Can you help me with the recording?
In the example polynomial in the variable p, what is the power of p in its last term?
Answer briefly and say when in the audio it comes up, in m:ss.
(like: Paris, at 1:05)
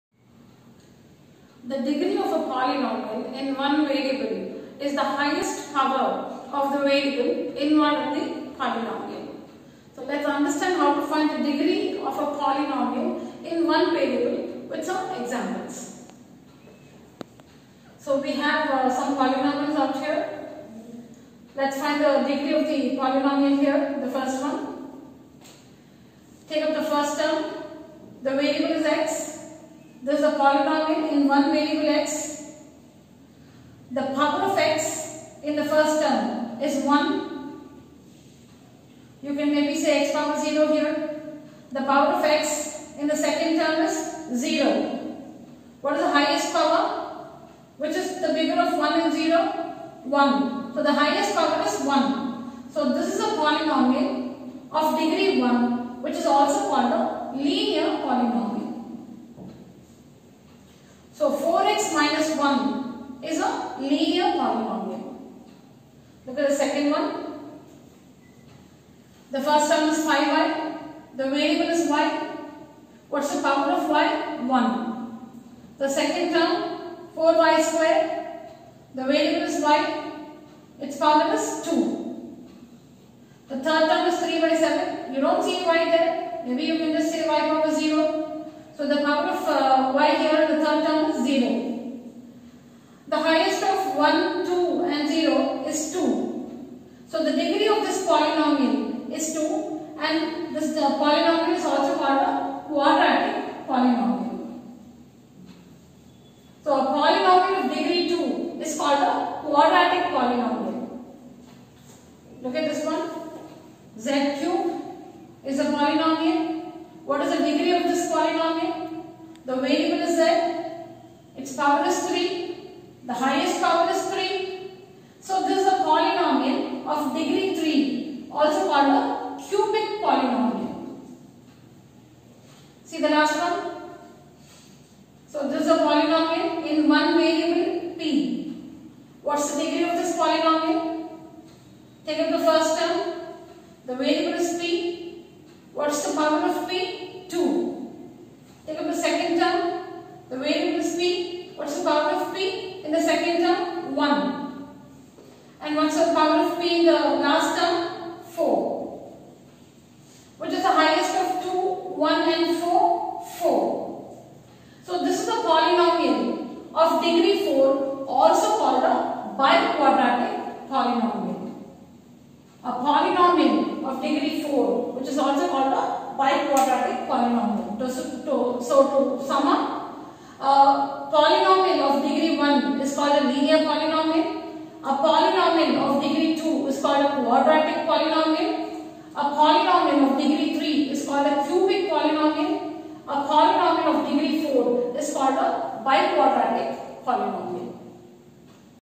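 4, at 2:38.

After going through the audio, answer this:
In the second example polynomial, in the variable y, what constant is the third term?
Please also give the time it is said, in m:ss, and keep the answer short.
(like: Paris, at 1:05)
3/7, at 1:24.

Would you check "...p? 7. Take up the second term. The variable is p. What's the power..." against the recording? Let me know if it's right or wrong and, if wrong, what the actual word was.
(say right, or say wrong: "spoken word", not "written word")
wrong: "2", not "7".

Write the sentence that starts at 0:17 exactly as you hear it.
So we have uh, some polynomials out here.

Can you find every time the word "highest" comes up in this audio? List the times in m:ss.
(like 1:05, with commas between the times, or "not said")
0:05, 0:46, 0:50, 2:40.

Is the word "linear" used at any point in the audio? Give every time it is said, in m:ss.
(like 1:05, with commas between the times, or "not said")
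0:57, 1:03, 3:03.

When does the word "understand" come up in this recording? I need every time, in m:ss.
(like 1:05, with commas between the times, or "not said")
0:10.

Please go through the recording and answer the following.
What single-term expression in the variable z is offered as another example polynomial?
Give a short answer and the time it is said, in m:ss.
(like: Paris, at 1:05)
z cube, at 1:54.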